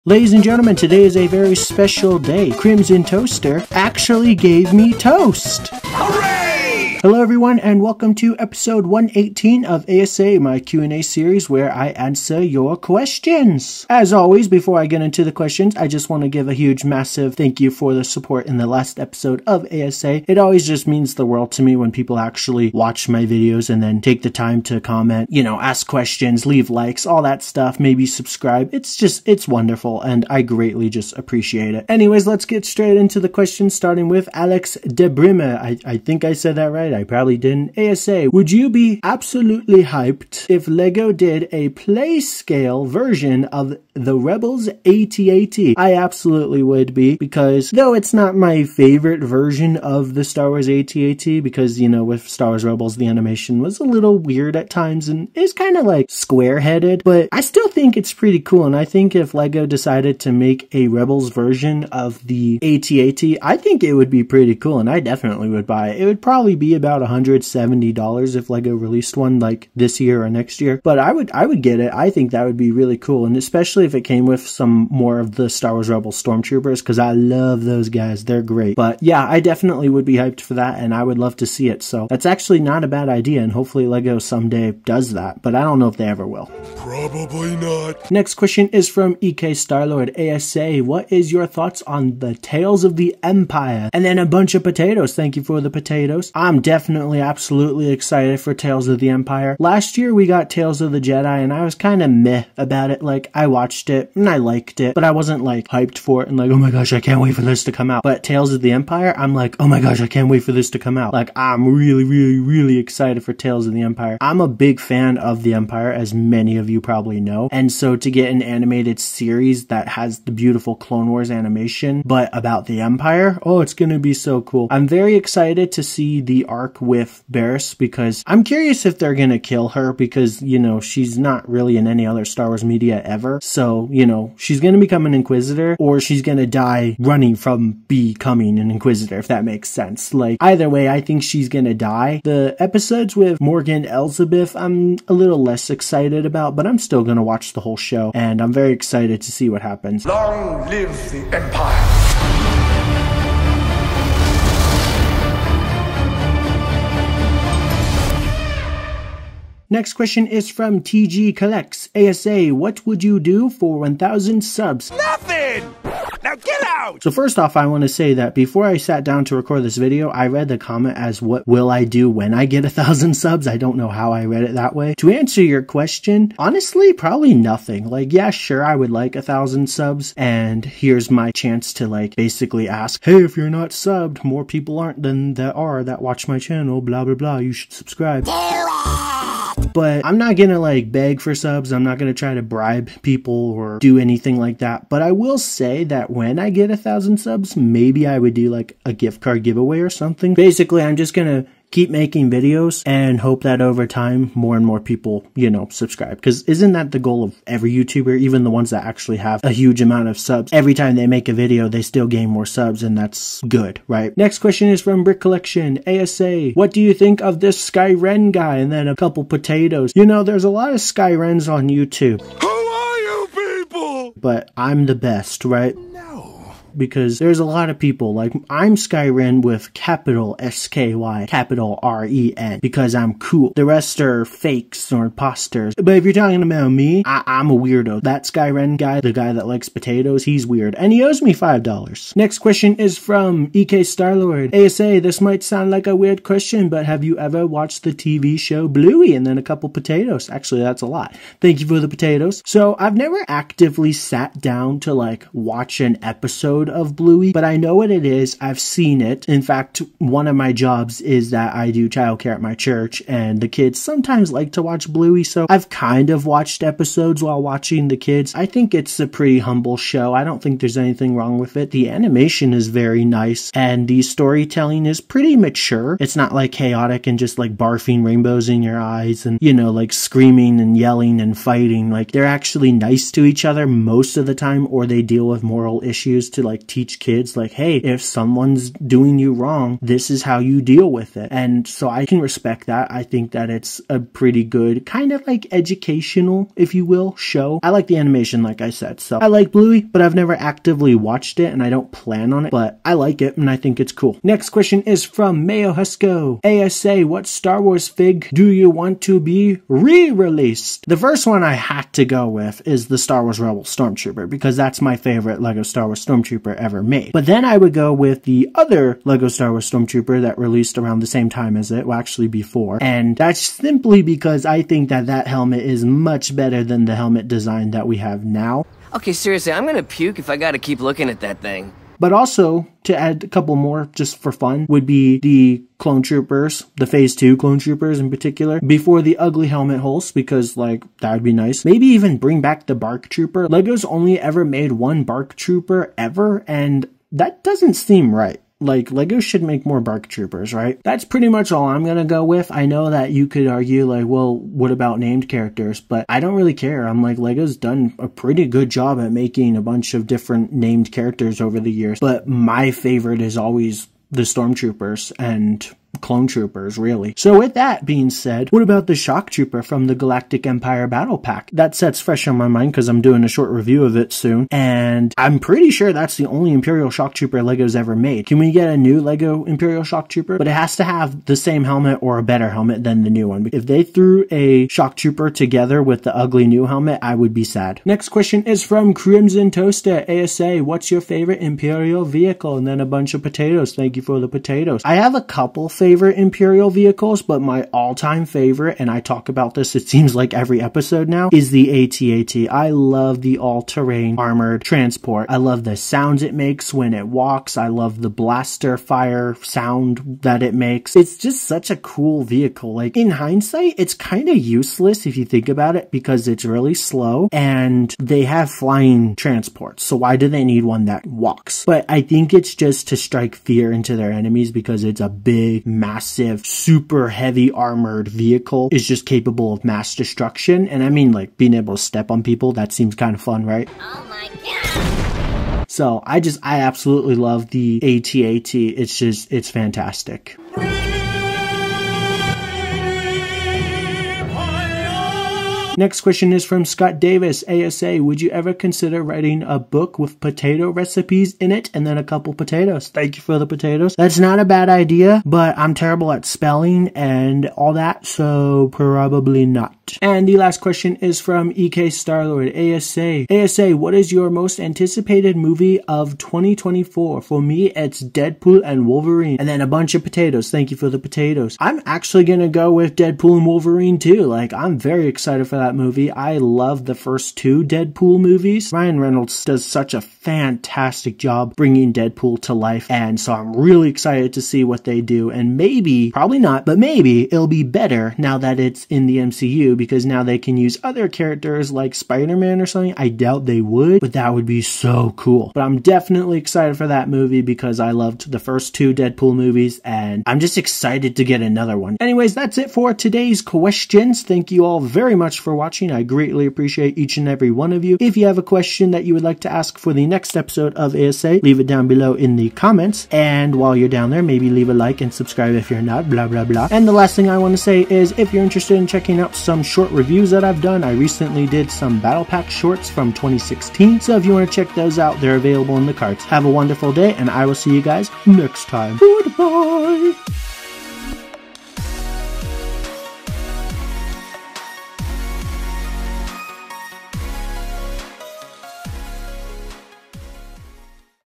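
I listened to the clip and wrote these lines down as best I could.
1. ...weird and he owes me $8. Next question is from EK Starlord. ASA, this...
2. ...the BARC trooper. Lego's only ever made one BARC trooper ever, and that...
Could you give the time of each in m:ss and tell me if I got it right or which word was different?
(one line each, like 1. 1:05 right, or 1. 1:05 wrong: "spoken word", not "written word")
1. 4:00 wrong: "5", not "8"
2. 5:42 right.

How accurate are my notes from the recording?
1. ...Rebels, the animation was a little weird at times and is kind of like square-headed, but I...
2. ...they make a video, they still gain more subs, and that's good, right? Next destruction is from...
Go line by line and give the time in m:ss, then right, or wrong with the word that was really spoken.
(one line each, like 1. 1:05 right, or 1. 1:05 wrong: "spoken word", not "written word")
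1. 0:52 right
2. 3:30 wrong: "question", not "destruction".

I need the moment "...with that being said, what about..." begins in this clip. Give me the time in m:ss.
6:07.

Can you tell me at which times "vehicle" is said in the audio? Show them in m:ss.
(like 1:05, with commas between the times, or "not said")
6:32, 6:36, 6:52, 7:08.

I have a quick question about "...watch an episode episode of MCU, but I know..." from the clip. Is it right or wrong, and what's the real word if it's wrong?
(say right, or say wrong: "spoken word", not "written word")
wrong: "Bluey", not "MCU".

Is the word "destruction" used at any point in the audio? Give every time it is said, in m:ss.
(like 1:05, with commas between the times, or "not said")
7:09.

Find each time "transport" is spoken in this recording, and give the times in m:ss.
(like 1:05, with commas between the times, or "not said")
6:44, 6:59.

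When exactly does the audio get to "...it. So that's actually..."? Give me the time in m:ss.
1:21.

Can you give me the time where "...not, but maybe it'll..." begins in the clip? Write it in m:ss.
8:06.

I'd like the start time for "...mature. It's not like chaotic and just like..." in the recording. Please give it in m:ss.
4:35.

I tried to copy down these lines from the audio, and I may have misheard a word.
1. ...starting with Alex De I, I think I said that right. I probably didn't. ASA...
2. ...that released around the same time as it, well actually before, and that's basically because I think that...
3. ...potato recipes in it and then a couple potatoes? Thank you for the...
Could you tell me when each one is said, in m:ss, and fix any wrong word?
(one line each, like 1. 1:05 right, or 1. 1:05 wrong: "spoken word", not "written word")
1. 0:33 right
2. 5:20 wrong: "simply", not "basically"
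3. 7:30 right.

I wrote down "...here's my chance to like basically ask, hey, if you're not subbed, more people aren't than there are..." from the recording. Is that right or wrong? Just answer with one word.
right.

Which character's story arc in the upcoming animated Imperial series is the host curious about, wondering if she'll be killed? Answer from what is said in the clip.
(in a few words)
Barriss.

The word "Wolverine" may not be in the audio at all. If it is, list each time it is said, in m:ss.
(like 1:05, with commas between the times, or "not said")
7:48, 7:53.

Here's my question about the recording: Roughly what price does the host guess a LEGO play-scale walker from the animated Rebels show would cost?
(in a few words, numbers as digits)
$170.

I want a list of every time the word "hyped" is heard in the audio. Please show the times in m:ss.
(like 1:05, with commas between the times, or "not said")
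0:39, 1:20, 1:45.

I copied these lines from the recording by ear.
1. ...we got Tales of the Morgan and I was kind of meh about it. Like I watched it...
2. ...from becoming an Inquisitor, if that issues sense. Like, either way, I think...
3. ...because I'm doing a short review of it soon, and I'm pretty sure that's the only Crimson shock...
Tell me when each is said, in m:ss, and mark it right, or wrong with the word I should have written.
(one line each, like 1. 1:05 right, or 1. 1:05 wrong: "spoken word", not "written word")
1. 1:40 wrong: "Jedi", not "Morgan"
2. 2:17 wrong: "makes", not "issues"
3. 6:12 wrong: "Imperial", not "Crimson".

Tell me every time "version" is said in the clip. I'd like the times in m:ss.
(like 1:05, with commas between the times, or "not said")
0:42, 0:49, 1:01.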